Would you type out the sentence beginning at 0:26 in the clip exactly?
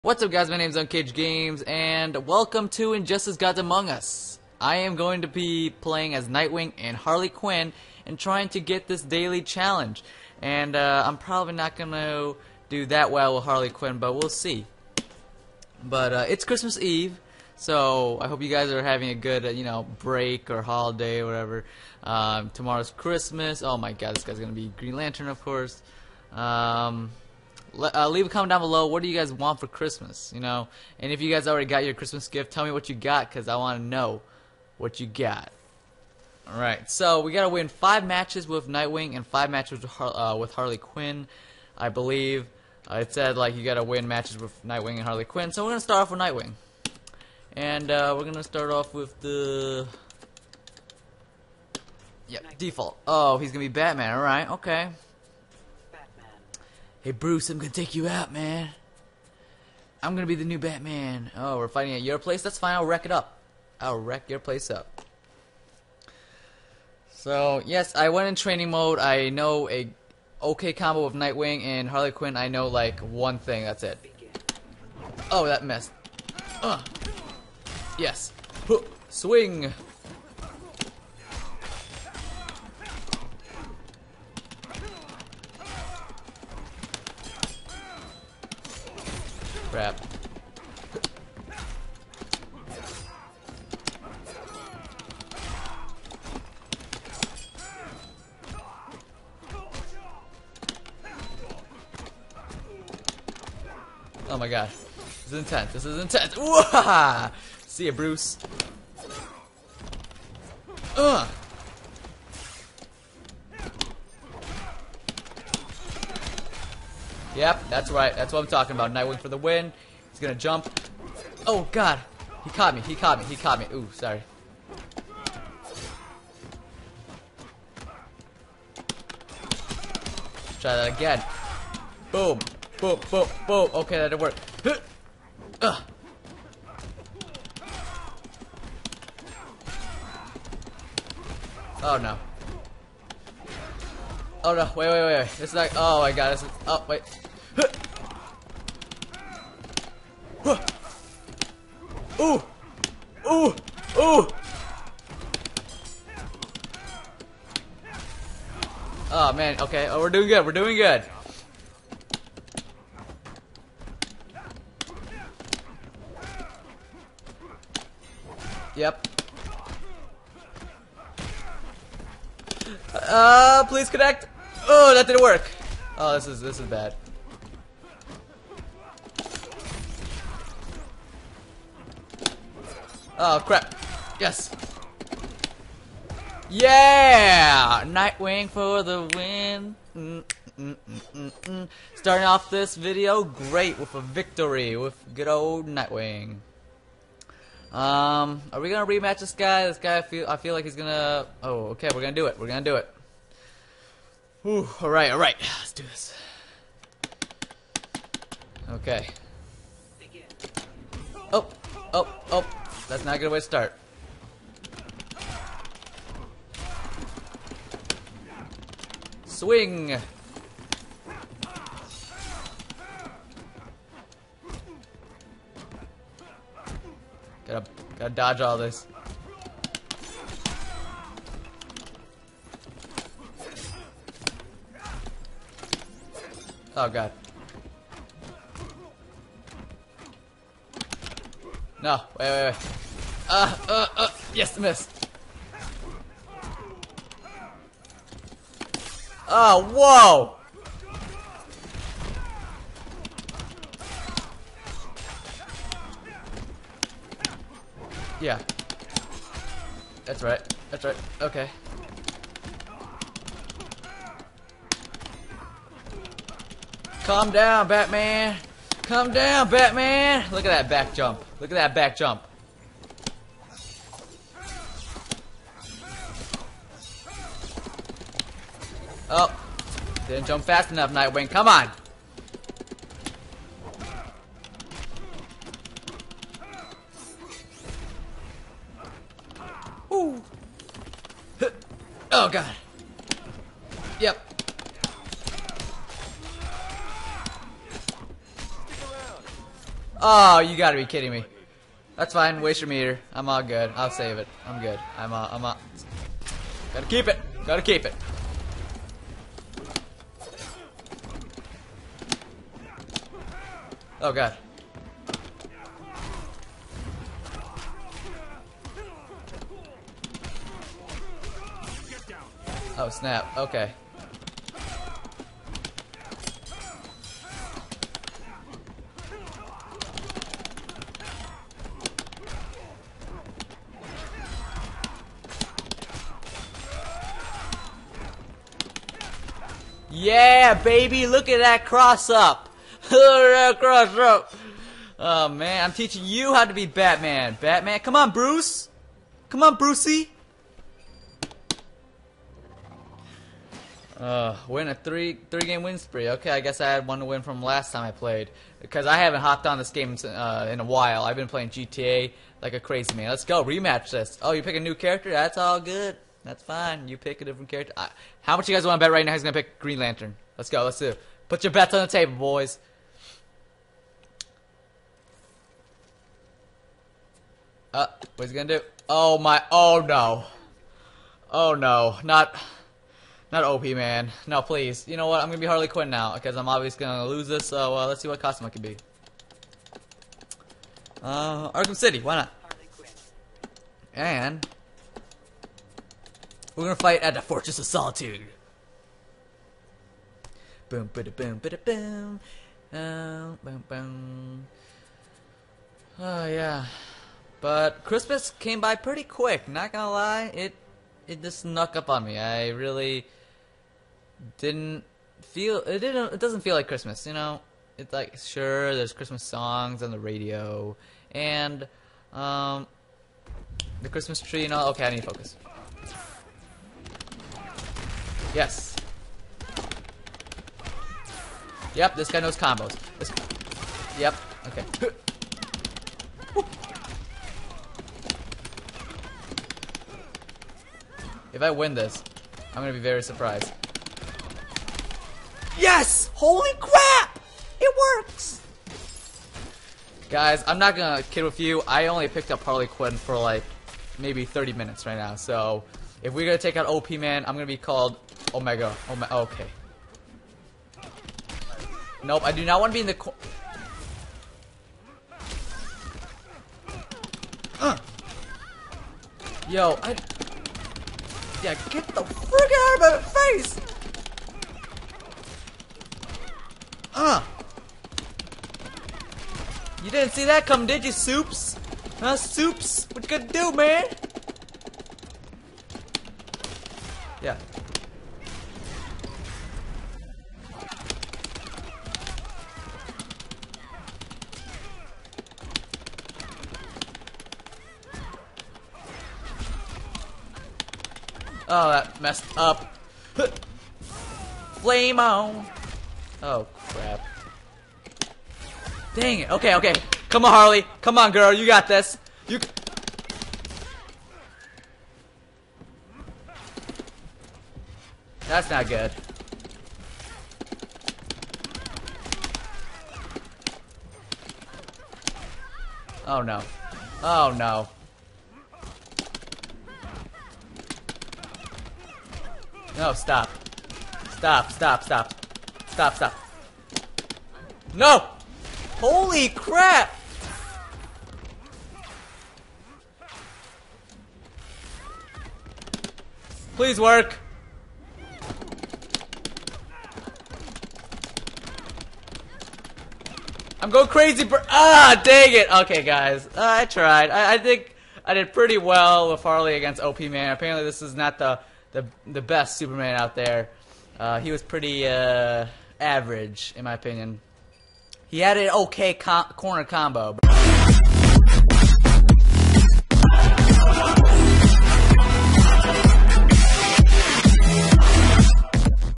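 Um, uh, leave a comment down below.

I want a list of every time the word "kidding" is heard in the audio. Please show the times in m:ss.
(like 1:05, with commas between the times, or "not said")
5:00.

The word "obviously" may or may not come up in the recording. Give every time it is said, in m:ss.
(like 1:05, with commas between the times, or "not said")
6:26.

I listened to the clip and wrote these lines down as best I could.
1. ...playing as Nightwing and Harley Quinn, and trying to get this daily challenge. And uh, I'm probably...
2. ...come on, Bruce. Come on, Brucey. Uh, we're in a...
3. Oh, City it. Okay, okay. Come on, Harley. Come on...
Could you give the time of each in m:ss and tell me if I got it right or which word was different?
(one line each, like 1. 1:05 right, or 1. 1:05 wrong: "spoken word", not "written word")
1. 0:05 right
2. 5:47 right
3. 8:26 wrong: "Dang", not "City".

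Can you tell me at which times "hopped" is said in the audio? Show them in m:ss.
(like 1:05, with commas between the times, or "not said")
5:59.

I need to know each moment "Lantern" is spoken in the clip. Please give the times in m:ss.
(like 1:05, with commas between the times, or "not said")
0:24, 6:09.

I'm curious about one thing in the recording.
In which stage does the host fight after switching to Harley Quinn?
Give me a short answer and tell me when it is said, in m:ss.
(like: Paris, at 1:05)
Fortress of Solitude, at 6:37.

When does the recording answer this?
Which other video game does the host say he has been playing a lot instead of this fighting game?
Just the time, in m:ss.
6:01.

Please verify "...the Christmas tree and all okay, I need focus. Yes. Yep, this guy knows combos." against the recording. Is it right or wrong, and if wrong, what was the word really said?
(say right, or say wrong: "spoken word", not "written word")
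right.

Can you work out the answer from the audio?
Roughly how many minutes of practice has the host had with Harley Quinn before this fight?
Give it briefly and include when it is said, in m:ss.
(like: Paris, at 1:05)
30, at 7:34.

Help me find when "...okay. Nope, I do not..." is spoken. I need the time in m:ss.
7:39.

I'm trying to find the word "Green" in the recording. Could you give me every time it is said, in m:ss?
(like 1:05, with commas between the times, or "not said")
0:24, 6:09.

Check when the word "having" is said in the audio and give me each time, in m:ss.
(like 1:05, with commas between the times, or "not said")
0:18.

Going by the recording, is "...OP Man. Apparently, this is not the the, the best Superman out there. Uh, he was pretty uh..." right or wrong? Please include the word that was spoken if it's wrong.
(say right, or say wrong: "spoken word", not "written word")
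right.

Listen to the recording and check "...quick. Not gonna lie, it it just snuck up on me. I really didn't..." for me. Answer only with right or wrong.
right.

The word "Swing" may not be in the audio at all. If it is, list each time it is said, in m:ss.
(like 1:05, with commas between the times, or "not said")
1:19, 3:39.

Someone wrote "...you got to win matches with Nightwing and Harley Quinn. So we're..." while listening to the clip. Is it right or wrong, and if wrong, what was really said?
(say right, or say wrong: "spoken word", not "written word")
right.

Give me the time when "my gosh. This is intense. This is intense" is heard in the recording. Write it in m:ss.
1:44.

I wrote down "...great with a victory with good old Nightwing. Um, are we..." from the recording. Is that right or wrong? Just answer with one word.
right.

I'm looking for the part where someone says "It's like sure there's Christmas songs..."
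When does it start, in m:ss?
6:57.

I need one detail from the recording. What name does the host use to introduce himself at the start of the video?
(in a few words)
Uncaged Games.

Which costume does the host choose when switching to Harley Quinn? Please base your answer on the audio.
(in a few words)
Arkham City.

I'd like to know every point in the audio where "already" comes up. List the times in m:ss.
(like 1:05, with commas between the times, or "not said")
0:31.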